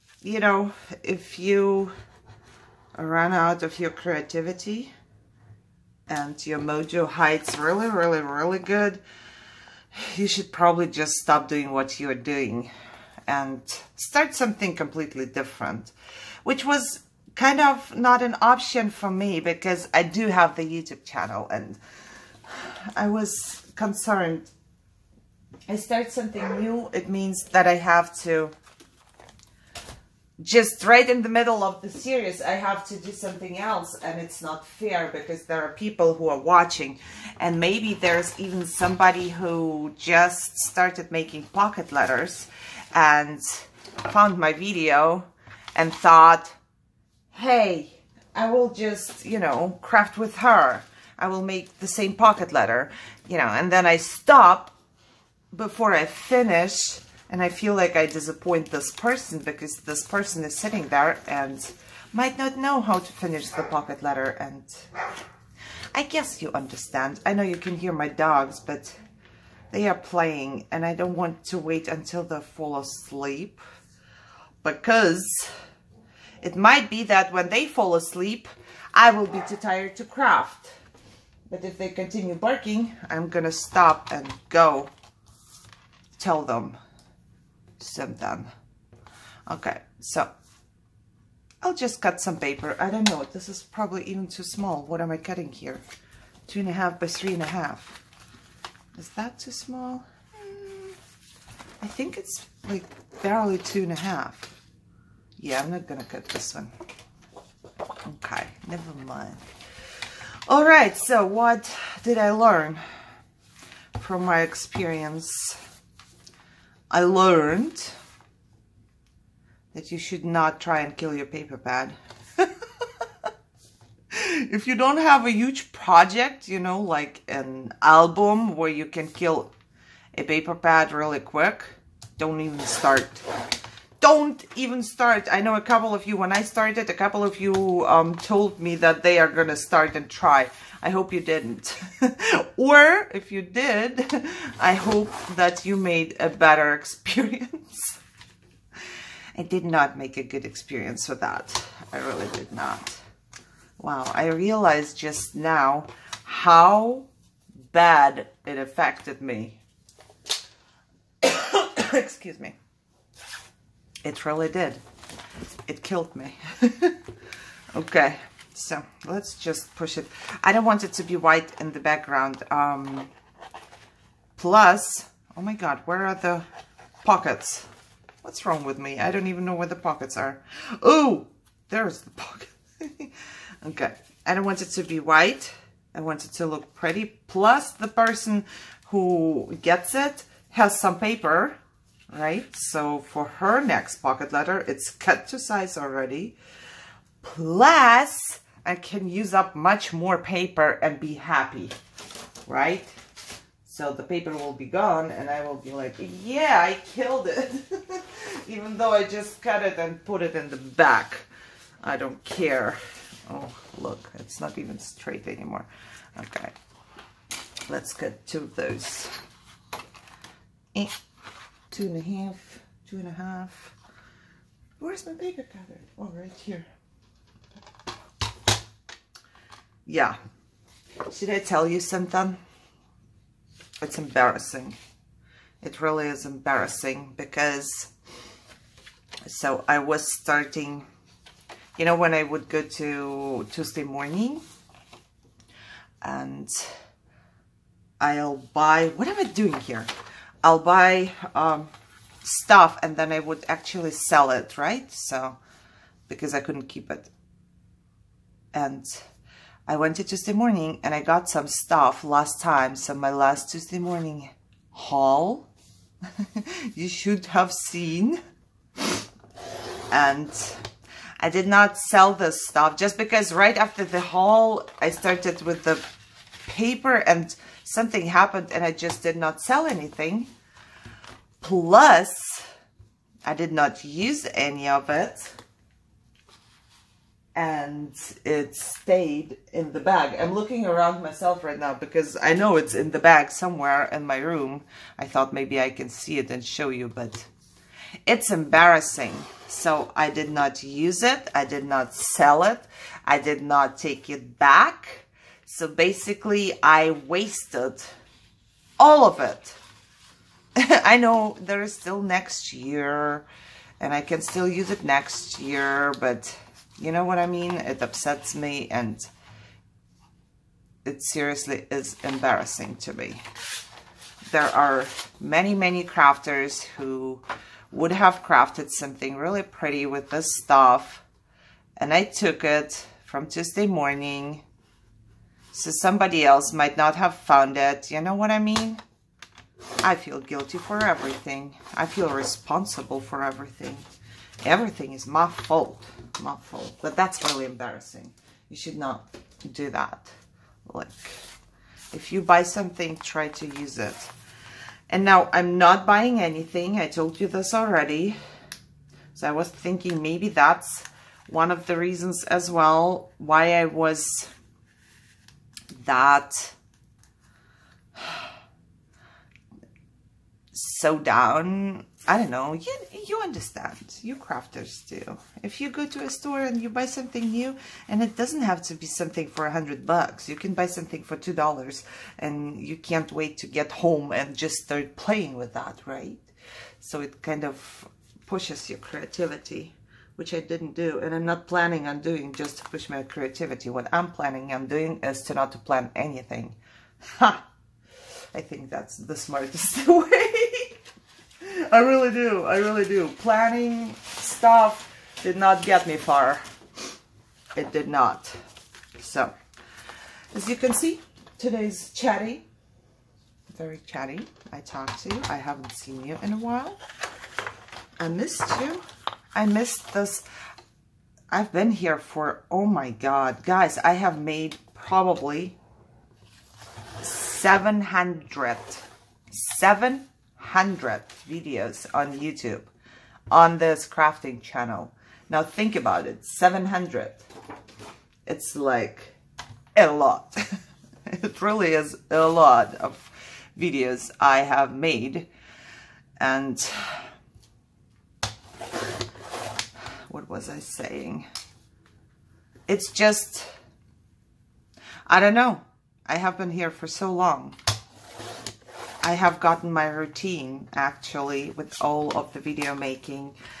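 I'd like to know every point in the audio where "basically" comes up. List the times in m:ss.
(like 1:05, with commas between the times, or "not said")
5:05.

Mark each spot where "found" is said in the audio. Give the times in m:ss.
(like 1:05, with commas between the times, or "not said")
0:44, 5:37.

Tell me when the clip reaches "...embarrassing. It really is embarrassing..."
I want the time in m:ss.
3:53.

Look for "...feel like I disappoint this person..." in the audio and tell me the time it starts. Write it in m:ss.
0:57.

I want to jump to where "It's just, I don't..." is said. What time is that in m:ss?
7:32.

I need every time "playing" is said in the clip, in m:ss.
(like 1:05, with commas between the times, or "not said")
1:09, 6:24.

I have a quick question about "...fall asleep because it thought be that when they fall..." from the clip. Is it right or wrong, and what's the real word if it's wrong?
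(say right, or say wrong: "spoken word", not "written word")
wrong: "might", not "thought".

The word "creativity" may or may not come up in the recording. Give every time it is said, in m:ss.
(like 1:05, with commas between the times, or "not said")
0:03, 6:28, 6:33.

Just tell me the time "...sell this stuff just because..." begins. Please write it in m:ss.
4:31.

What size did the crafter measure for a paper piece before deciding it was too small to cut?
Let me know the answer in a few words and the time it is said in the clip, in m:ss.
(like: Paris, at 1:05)
2.5 by 3.5, at 1:36.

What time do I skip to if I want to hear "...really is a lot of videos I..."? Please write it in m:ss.
7:21.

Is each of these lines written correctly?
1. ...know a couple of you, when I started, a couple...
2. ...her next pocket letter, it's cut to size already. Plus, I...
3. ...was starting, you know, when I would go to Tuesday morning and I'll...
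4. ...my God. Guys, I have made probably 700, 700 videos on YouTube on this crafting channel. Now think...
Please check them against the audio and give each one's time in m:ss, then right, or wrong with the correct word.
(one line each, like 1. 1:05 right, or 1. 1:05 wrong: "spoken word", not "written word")
1. 2:15 right
2. 3:13 right
3. 3:59 right
4. 7:02 right.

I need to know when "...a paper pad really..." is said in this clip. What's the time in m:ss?
2:10.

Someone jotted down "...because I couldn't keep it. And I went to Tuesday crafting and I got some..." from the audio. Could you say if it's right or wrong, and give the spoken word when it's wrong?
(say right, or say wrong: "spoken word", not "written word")
wrong: "morning", not "crafting".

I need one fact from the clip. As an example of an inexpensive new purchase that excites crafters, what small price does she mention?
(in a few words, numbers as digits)
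2 dollars.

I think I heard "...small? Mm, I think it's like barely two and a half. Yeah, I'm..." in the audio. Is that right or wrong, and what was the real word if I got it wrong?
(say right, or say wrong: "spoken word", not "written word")
right.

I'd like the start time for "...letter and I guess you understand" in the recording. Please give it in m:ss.
1:04.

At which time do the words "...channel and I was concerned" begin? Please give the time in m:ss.
0:21.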